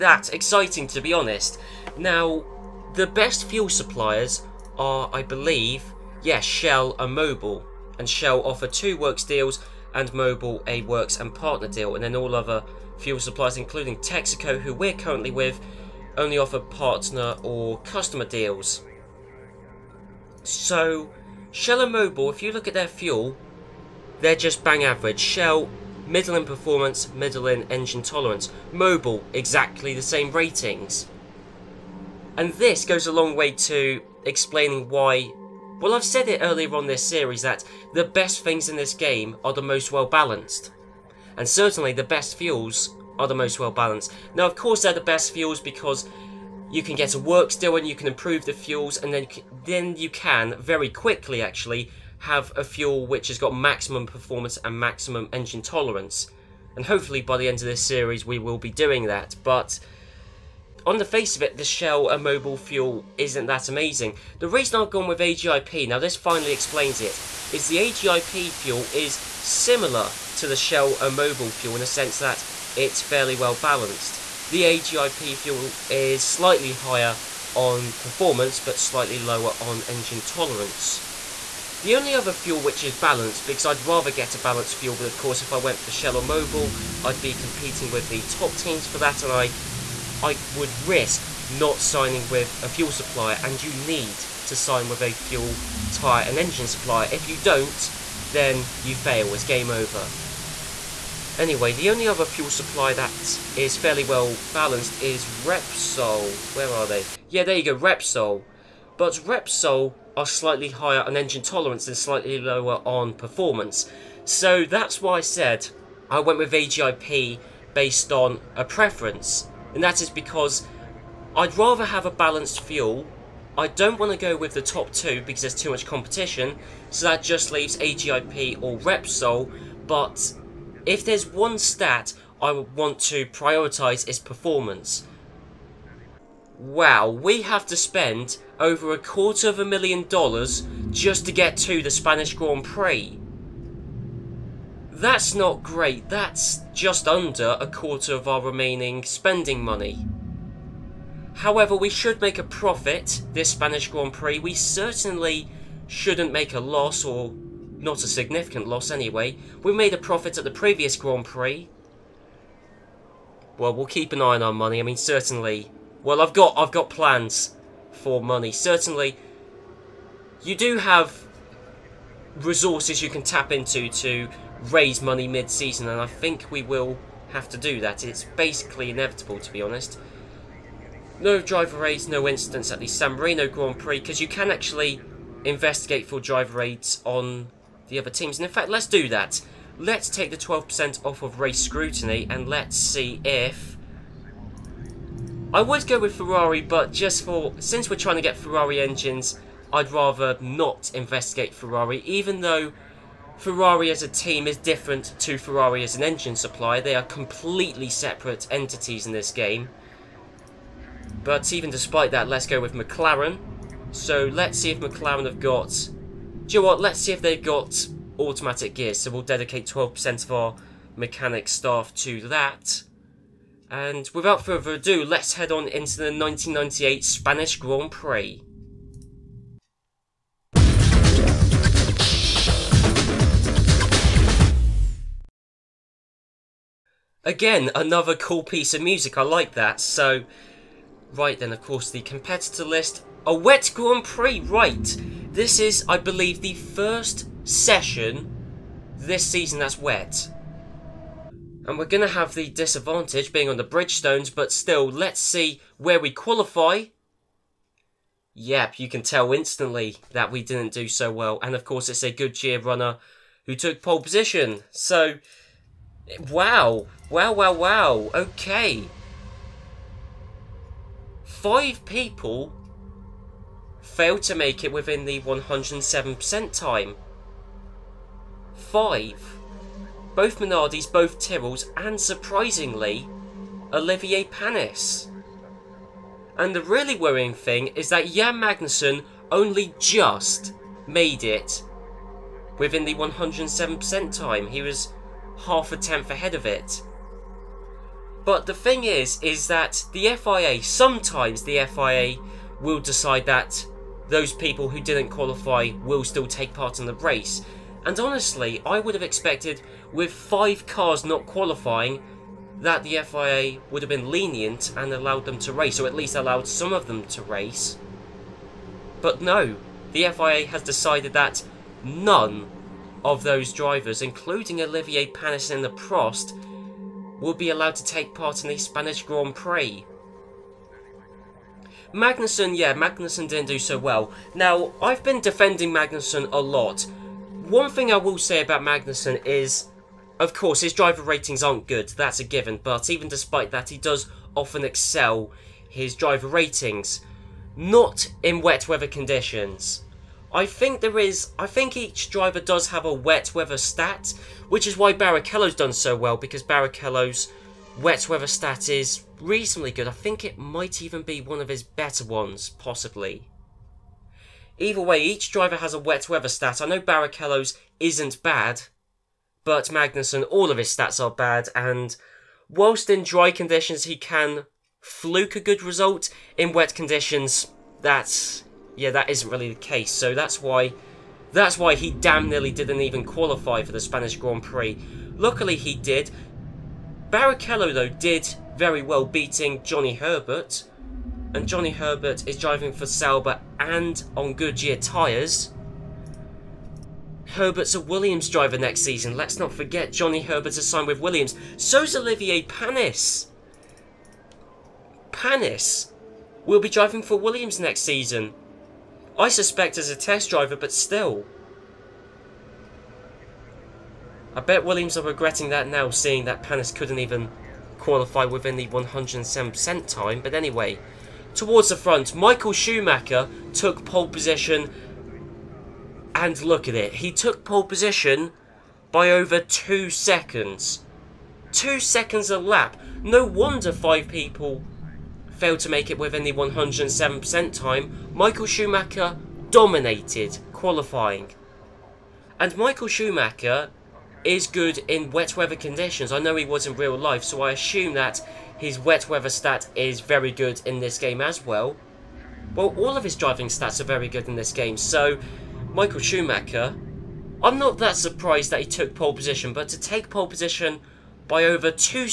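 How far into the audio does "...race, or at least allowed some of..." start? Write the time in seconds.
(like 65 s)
315 s.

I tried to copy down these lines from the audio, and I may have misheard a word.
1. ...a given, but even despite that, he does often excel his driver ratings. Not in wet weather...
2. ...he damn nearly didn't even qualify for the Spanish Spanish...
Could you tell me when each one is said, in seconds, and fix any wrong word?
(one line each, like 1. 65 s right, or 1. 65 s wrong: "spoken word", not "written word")
1. 342 s right
2. 381 s wrong: "Grand", not "Spanish".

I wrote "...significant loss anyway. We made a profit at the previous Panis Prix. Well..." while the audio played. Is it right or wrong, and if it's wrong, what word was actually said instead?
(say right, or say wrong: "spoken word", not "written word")
wrong: "Grand", not "Panis".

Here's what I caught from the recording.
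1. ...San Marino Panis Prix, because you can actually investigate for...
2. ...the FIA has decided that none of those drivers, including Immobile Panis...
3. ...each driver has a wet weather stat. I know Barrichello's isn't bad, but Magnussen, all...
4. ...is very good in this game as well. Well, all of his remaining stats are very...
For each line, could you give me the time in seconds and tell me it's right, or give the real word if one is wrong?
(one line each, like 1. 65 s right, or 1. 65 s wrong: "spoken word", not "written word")
1. 182 s wrong: "Grand", not "Panis"
2. 319 s wrong: "Olivier", not "Immobile"
3. 365 s right
4. 449 s wrong: "driving", not "remaining".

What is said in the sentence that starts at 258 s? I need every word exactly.
Yep, you can tell instantly that we didn't do so well.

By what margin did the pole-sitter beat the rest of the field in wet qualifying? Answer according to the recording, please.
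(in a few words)
over two seconds.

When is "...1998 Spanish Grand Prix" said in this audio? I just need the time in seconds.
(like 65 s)
226 s.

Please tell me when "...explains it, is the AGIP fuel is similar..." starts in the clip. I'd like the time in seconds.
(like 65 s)
66 s.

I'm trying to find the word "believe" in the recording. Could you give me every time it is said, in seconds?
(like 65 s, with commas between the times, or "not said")
5 s, 245 s.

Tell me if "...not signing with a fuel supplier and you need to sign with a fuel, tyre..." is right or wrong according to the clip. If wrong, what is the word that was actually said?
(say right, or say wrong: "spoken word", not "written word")
right.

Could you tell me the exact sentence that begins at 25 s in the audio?
Shell, middle in performance, middle in engine tolerance.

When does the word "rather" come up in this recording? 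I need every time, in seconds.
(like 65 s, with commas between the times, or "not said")
83 s, 121 s, 199 s.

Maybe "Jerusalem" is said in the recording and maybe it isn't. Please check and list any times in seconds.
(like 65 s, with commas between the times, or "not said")
not said.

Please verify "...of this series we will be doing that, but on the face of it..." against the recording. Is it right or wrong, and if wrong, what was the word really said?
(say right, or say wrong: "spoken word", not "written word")
right.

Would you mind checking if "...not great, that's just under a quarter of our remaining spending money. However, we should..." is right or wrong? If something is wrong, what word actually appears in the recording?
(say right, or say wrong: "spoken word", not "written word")
right.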